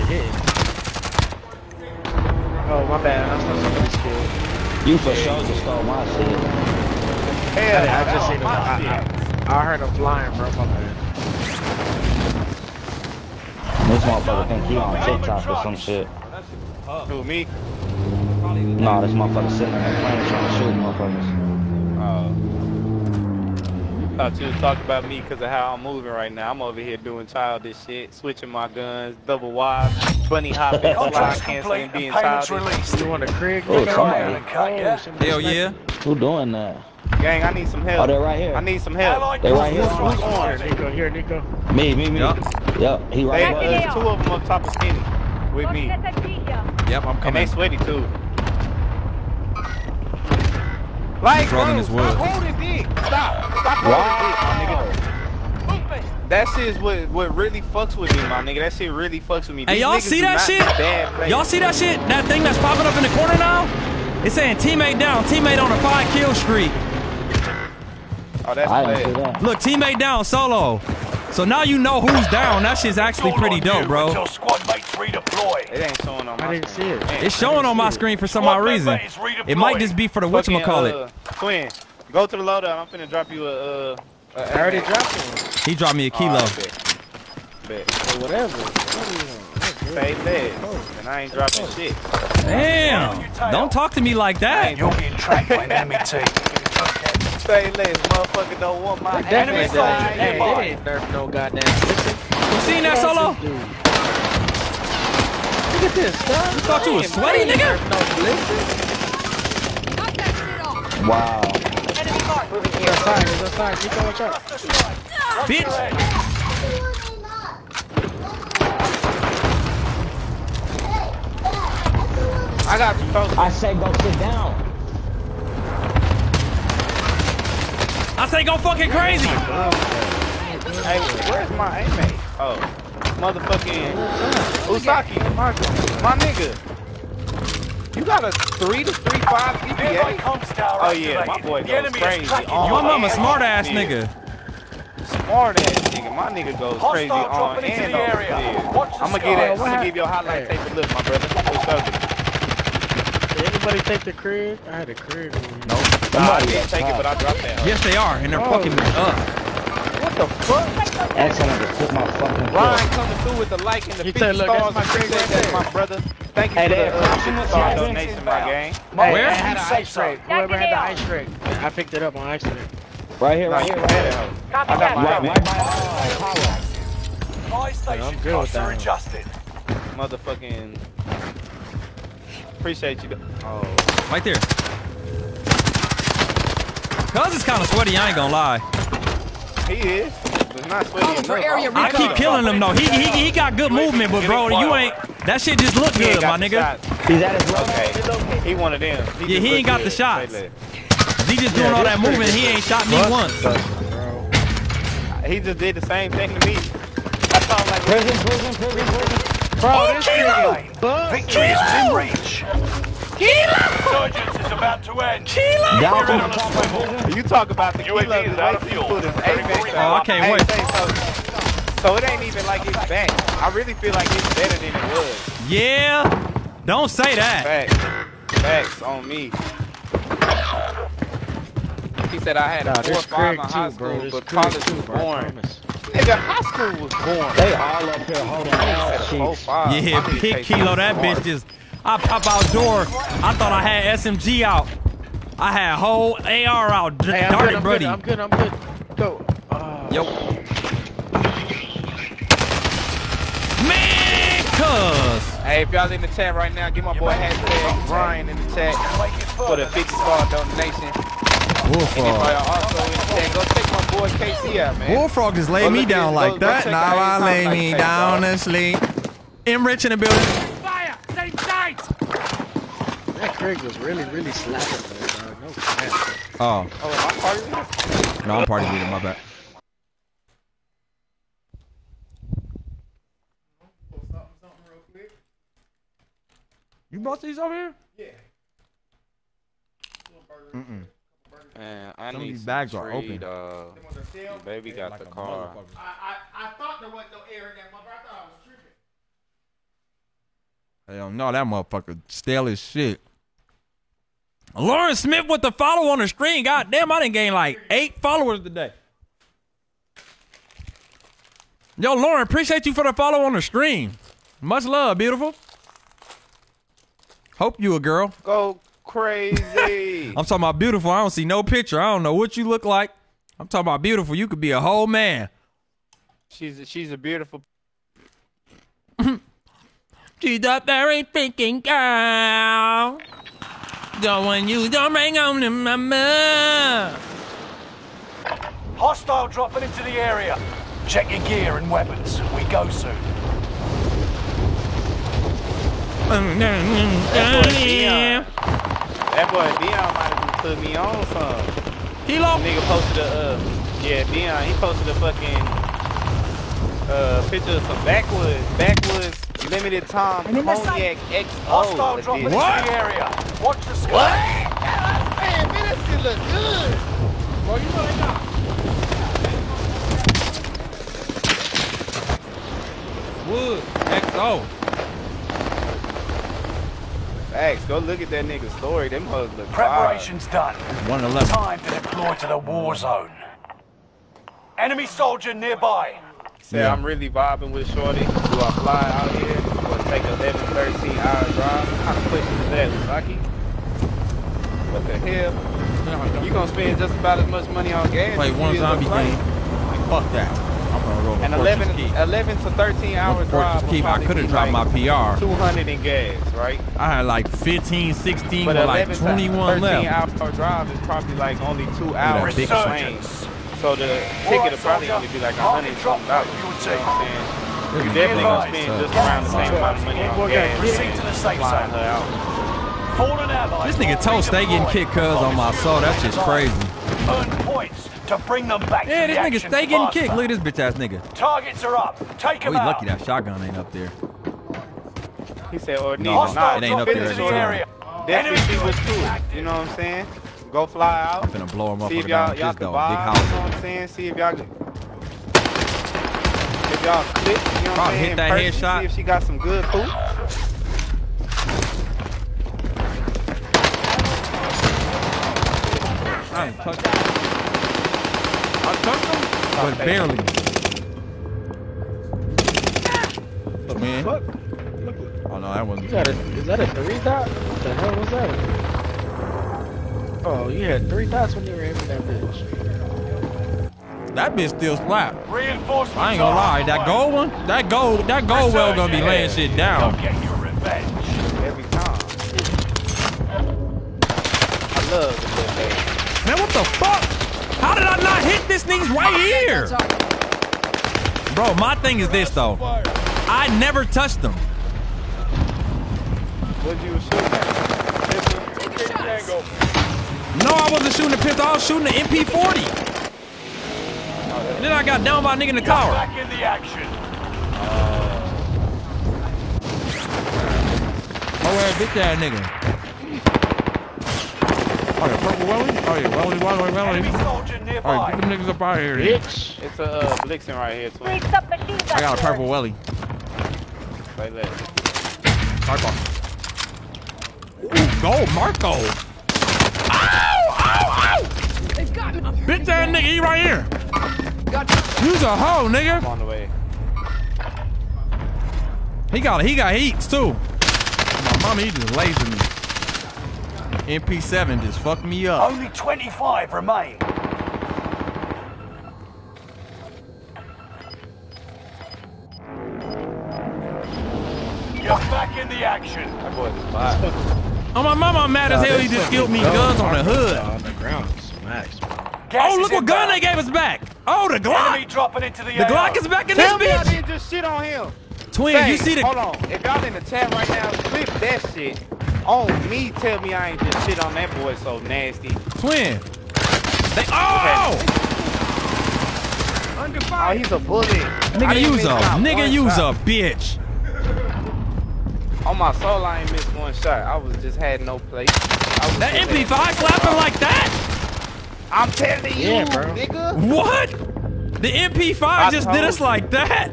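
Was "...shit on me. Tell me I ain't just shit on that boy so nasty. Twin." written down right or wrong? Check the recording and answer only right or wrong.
right.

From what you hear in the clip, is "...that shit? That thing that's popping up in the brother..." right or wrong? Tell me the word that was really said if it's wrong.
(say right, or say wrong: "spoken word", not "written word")
wrong: "corner", not "brother".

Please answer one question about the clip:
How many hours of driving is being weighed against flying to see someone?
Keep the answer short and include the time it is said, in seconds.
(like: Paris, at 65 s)
11 to 13 hours, at 390 s.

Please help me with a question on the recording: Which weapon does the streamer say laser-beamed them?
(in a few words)
MP7.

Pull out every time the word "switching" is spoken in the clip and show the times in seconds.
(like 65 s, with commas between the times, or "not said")
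28 s.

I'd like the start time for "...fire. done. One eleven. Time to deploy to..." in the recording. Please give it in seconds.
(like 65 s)
380 s.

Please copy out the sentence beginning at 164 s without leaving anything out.
That's my, great that's right my brother.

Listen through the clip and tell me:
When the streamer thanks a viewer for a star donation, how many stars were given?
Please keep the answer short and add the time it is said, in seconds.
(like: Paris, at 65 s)
50, at 259 s.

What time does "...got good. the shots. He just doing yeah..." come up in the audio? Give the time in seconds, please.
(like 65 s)
199 s.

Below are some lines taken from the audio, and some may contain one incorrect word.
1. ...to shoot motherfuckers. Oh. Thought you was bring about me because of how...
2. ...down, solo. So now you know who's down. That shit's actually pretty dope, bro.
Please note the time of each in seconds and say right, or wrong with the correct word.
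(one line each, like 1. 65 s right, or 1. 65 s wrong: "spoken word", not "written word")
1. 20 s wrong: "talking", not "bring"
2. 69 s right.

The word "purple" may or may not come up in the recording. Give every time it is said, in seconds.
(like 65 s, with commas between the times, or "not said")
515 s, 522 s.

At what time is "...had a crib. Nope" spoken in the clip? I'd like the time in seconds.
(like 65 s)
154 s.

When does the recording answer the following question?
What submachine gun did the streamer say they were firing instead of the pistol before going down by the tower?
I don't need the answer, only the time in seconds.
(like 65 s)
501 s.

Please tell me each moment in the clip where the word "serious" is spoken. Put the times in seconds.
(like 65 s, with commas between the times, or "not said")
not said.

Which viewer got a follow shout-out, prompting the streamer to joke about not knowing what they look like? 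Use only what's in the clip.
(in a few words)
Lauren Smith.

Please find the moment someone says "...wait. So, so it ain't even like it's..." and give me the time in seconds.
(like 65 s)
220 s.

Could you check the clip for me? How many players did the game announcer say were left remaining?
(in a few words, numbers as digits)
25.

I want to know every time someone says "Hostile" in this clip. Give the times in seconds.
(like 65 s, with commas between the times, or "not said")
338 s, 361 s.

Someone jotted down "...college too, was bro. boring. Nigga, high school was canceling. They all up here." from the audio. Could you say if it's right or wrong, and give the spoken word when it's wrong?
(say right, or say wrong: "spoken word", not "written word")
wrong: "boring", not "canceling".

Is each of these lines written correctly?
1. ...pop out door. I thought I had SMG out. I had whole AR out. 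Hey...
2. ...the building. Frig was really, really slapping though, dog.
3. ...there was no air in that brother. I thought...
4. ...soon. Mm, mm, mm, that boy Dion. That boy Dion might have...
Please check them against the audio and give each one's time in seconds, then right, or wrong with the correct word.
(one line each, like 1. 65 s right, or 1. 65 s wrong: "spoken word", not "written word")
1. 241 s right
2. 269 s right
3. 296 s wrong: "motherfucker", not "brother"
4. 342 s right.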